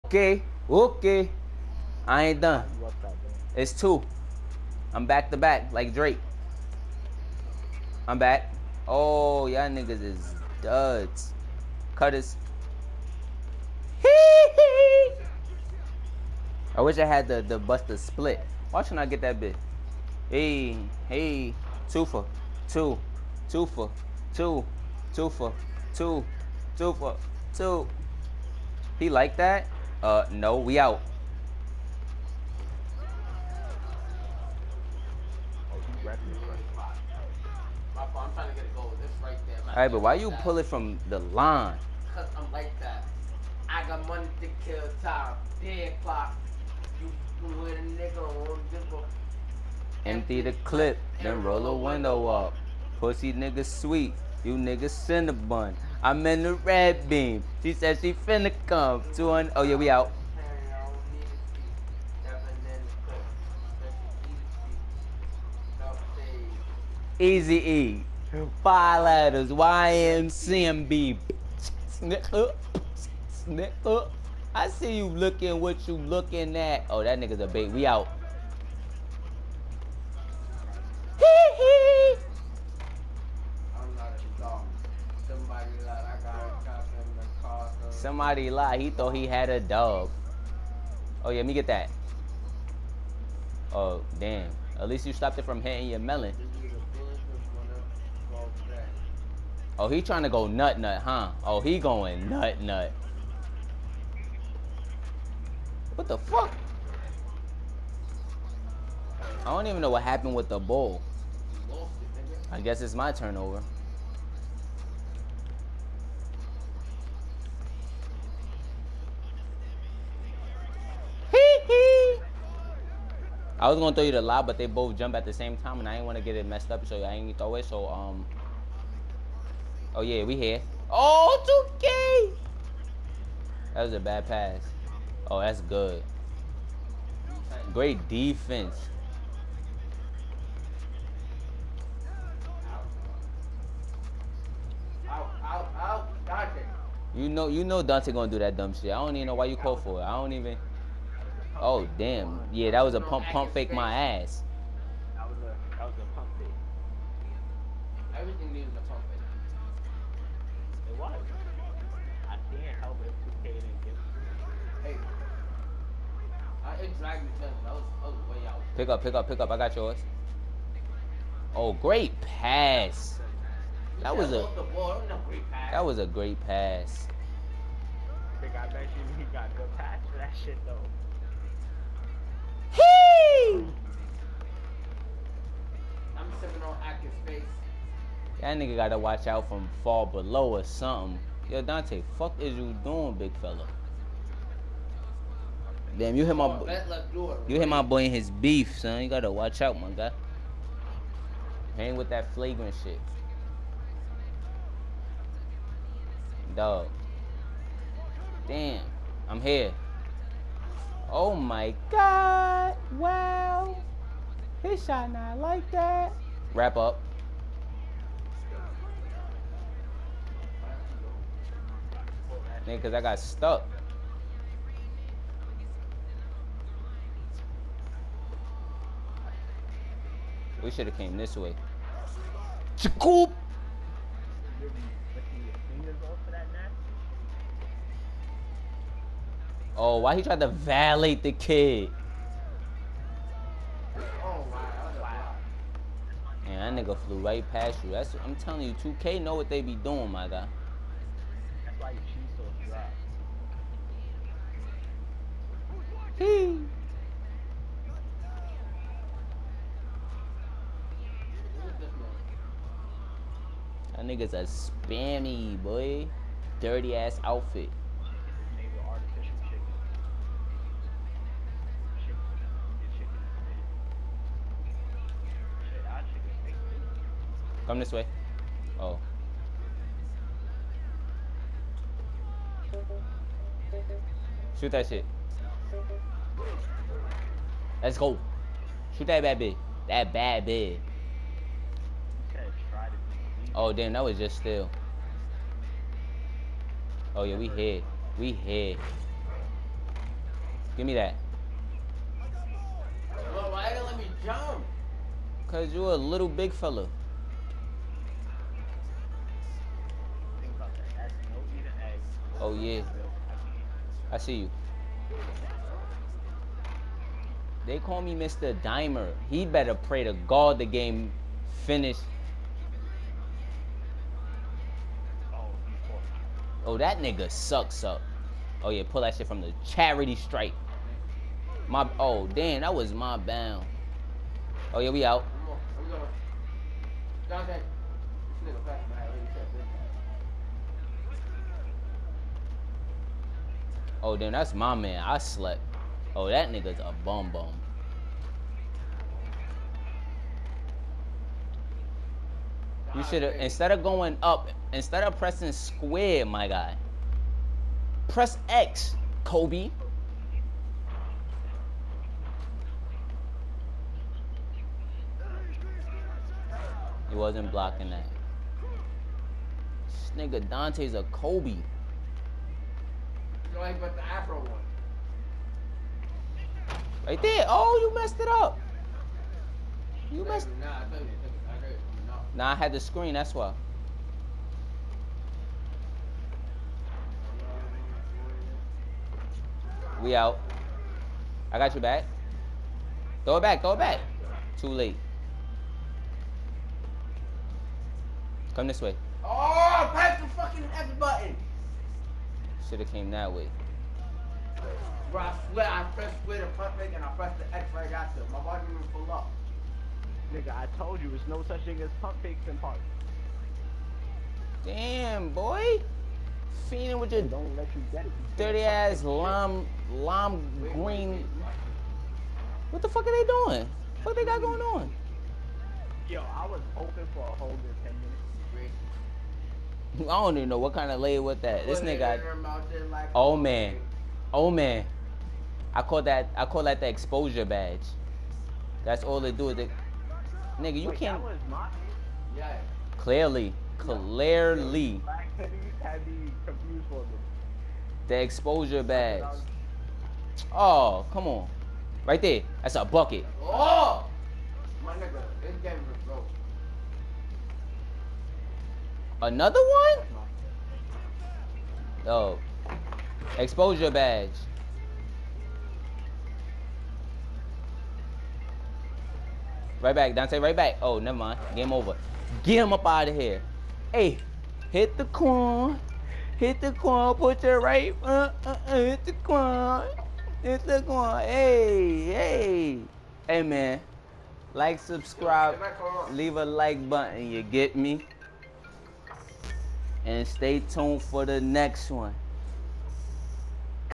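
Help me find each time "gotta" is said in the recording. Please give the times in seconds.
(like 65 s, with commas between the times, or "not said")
188 s, 199 s.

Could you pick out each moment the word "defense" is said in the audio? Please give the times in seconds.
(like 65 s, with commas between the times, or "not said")
138 s.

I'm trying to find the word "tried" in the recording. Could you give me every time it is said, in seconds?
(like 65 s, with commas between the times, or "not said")
240 s.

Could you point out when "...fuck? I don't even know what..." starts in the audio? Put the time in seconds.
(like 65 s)
106 s.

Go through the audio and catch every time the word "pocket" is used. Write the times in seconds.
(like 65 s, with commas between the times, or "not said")
not said.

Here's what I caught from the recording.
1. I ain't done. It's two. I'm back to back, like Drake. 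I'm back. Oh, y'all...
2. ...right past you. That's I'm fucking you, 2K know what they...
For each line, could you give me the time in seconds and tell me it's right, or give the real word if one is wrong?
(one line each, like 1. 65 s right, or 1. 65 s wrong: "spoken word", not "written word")
1. 2 s right
2. 247 s wrong: "telling", not "fucking".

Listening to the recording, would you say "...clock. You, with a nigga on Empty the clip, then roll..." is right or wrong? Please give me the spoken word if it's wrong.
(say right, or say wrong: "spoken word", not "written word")
right.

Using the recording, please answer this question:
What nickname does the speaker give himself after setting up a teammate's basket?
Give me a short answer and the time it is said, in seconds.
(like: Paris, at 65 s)
Mr. Dimer, at 318 s.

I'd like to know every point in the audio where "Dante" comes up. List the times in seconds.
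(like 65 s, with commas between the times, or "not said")
147 s, 191 s, 370 s, 470 s.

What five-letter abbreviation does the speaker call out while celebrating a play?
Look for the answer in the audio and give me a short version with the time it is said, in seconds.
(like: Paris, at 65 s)
YMCMB, at 69 s.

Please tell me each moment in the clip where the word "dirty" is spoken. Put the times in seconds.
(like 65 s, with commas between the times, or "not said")
266 s, 418 s.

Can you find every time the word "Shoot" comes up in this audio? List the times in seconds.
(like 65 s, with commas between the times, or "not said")
284 s, 288 s.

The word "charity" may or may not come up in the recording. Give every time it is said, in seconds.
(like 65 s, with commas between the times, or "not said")
329 s.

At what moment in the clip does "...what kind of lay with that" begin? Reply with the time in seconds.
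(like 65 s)
430 s.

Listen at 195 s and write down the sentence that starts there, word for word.
Damn, you hit my you hit my boy in his beef, son.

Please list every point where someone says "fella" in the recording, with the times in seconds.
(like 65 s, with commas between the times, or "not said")
193 s, 306 s.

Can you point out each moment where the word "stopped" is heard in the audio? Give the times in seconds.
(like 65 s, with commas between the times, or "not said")
95 s.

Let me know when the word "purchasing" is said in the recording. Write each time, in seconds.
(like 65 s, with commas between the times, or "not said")
not said.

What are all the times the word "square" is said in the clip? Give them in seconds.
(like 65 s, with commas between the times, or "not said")
355 s, 406 s.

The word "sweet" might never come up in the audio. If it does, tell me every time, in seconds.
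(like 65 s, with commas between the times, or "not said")
53 s.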